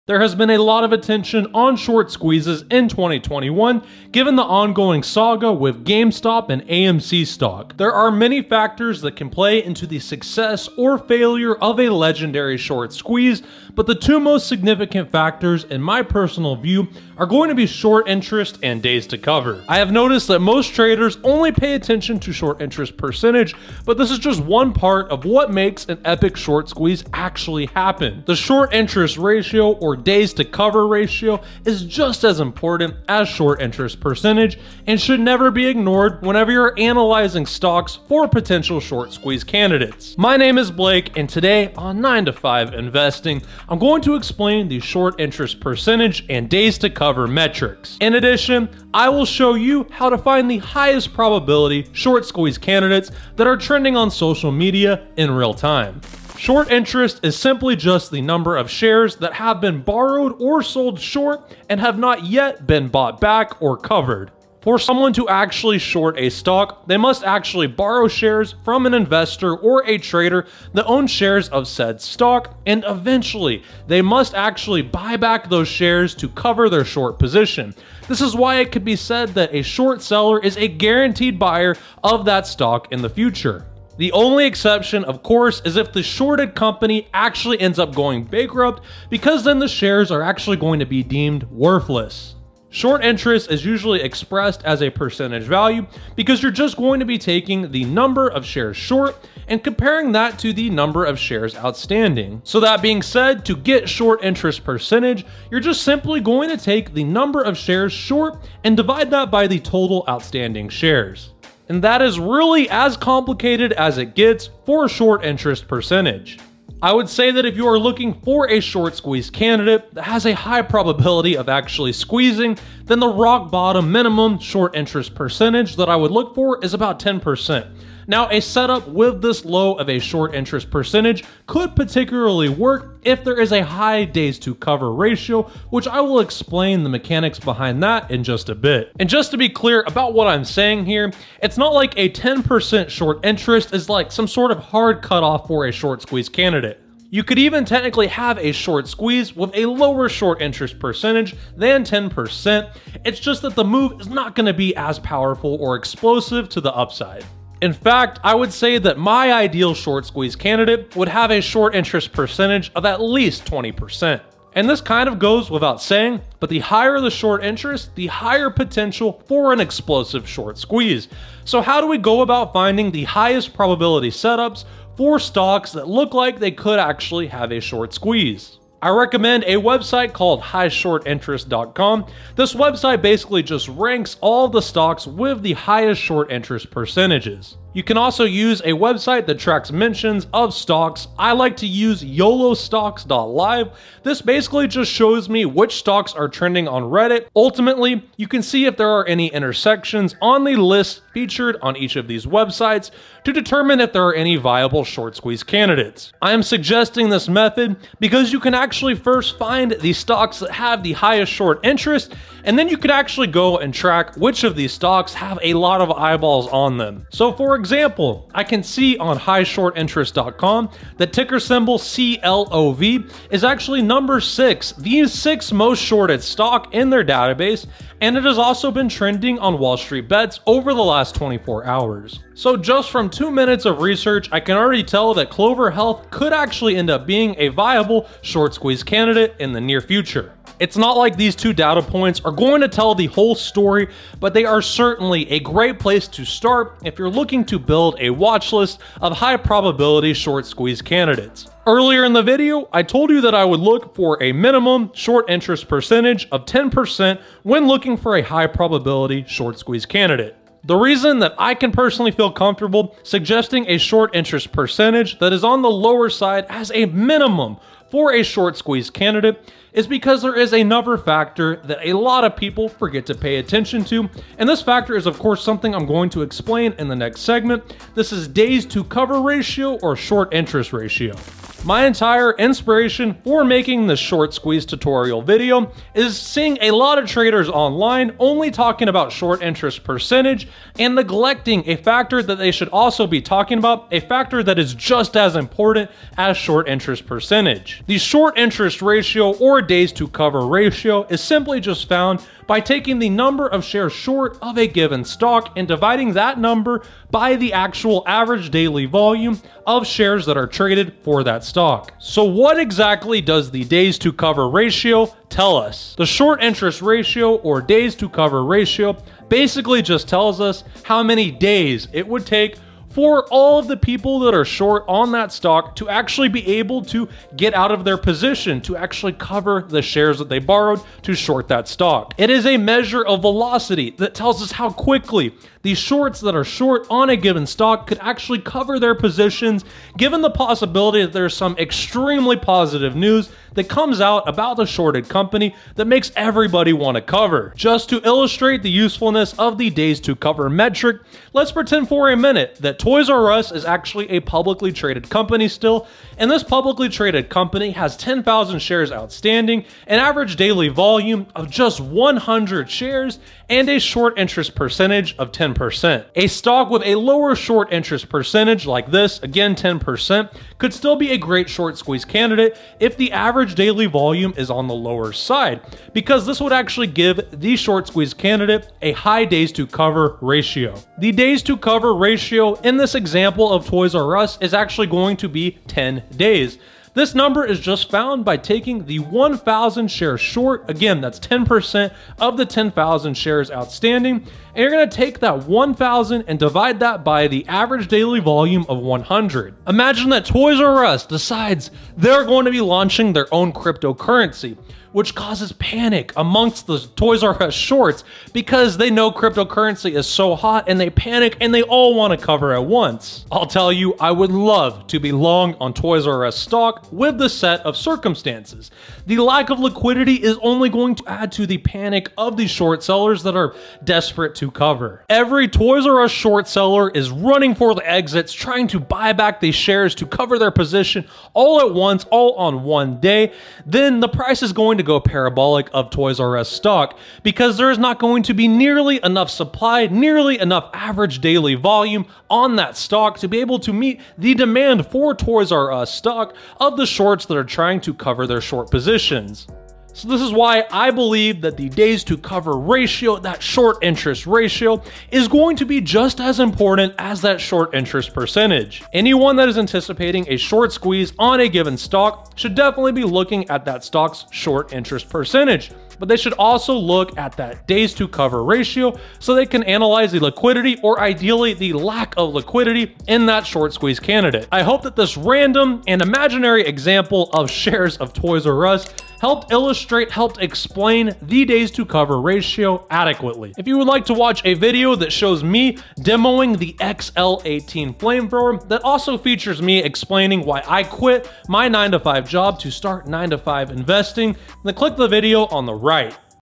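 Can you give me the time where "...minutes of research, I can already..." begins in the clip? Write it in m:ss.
3:53.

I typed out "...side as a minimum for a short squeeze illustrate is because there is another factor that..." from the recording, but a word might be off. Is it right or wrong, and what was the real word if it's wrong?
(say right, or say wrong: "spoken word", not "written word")
wrong: "candidate", not "illustrate".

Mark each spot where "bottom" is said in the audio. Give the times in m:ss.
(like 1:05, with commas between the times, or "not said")
2:03.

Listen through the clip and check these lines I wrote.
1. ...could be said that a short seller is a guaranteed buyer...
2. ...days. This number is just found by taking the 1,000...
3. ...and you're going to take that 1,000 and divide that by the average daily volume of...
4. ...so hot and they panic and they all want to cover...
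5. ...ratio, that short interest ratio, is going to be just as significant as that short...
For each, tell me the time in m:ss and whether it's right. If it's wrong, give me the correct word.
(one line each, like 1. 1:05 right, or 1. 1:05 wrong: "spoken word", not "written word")
1. 1:18 right
2. 6:26 right
3. 6:34 right
4. 6:50 right
5. 7:32 wrong: "important", not "significant".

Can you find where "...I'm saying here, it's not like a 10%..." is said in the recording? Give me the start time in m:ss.
2:20.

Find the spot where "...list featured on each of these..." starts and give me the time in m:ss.
3:20.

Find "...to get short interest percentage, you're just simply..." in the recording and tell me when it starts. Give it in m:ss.
1:43.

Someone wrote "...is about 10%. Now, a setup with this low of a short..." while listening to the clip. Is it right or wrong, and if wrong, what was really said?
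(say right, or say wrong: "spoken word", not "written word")
right.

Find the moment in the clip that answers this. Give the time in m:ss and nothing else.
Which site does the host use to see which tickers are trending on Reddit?
3:12.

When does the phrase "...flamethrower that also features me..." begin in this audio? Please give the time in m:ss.
8:07.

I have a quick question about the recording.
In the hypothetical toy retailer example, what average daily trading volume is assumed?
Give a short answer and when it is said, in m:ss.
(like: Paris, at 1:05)
100 shares, at 6:01.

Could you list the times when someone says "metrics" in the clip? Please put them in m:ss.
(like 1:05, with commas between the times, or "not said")
0:47, 5:50.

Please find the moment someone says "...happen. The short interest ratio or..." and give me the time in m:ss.
0:27.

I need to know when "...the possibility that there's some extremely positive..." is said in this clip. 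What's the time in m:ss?
5:40.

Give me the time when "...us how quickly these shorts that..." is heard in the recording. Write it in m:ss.
5:34.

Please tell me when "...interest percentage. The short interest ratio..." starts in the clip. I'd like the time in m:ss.
4:56.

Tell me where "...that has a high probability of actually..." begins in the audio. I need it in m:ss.
1:59.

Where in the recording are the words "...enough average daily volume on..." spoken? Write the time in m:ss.
7:20.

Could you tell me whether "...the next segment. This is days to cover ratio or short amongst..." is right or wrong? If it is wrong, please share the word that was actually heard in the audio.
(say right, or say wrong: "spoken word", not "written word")
wrong: "interest", not "amongst".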